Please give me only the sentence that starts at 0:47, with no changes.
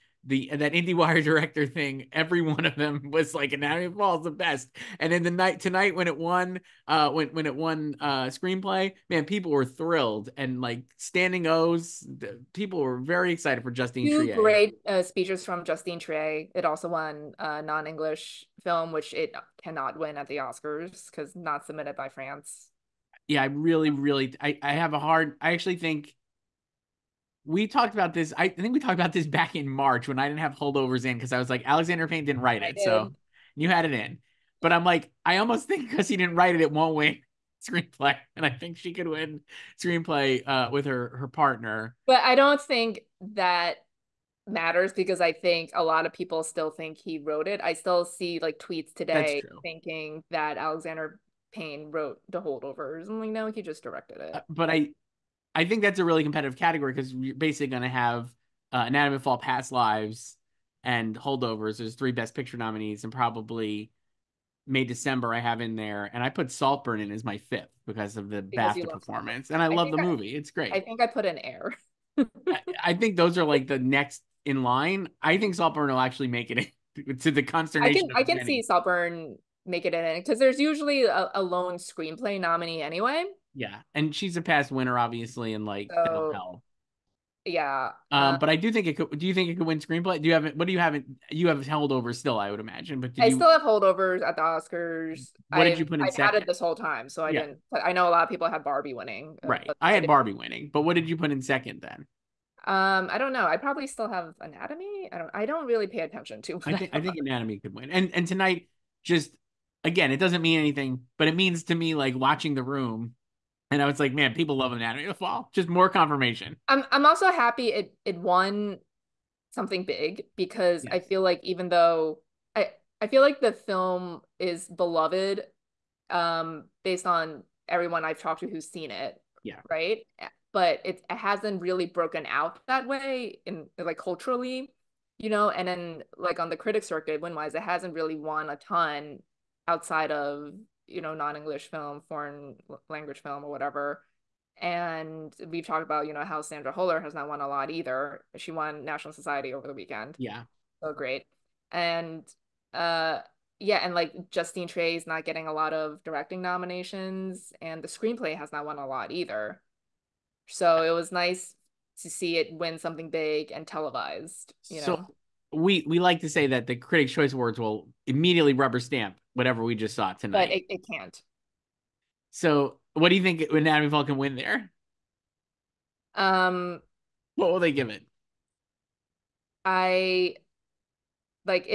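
I still see like tweets today thinking that Alexander Payne wrote the holdovers.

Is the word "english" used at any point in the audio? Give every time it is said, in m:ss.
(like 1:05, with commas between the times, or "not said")
0:17, 2:21.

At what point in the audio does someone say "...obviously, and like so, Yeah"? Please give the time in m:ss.
1:24.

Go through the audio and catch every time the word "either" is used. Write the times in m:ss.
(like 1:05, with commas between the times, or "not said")
2:27, 2:39.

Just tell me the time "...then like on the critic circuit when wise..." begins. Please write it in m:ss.
2:15.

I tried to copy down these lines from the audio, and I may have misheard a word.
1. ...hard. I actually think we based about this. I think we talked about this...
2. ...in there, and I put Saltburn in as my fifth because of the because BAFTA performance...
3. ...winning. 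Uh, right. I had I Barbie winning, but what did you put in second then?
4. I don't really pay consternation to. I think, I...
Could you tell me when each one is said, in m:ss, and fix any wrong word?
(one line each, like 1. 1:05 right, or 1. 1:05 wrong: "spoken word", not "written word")
1. 0:24 wrong: "talked", not "based"
2. 1:05 right
3. 1:38 right
4. 1:45 wrong: "attention", not "consternation".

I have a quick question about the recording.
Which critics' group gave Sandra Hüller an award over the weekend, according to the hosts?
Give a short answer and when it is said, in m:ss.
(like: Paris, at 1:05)
National Society, at 2:28.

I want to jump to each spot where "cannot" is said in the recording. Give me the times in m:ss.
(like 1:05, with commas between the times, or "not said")
0:19.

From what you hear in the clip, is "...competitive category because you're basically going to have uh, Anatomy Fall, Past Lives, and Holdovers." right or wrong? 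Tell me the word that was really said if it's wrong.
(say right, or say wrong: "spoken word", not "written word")
right.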